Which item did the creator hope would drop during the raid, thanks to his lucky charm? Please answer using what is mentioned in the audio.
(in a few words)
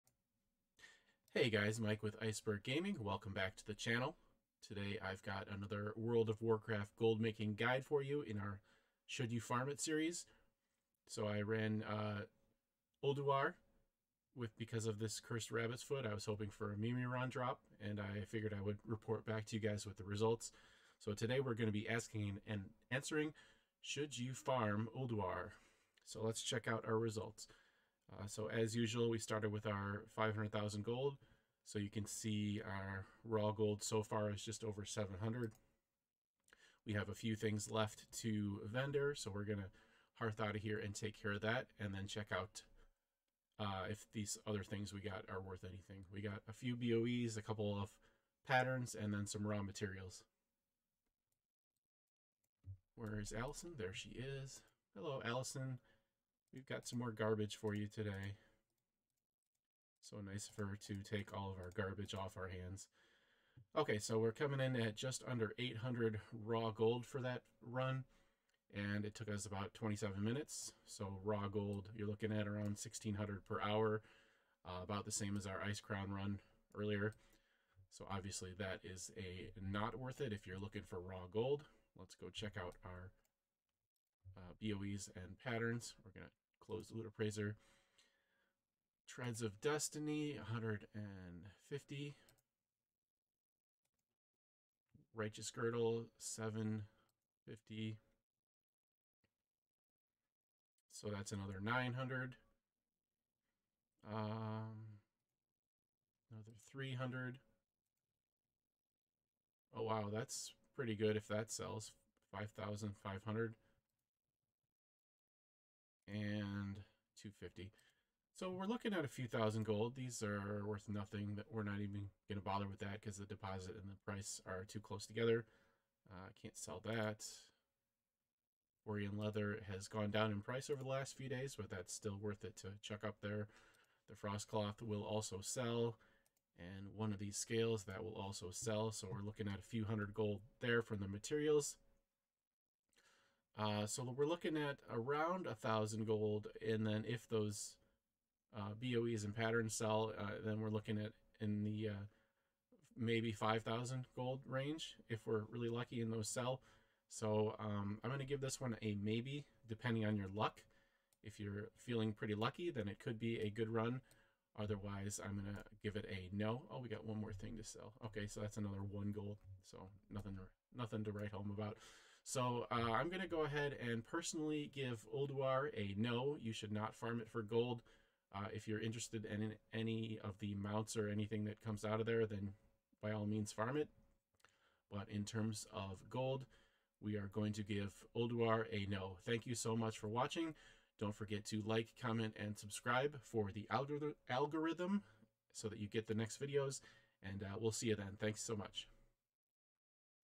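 Mimiron.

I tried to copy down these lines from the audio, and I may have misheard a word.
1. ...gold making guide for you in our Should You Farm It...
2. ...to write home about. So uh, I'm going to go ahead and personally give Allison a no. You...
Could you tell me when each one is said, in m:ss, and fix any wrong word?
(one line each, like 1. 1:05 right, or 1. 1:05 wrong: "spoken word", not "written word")
1. 0:06 right
2. 2:51 wrong: "Ulduar", not "Allison".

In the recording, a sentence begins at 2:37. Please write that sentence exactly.
So um, I'm going to give this one a maybe, depending on your luck.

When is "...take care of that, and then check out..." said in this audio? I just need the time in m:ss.
0:40.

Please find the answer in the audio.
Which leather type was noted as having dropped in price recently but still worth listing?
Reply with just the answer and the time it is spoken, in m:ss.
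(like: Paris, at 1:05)
Borean leather, at 2:08.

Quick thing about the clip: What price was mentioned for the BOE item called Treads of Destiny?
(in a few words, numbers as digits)
150.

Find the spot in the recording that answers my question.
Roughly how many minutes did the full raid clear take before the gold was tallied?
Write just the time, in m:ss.
1:09.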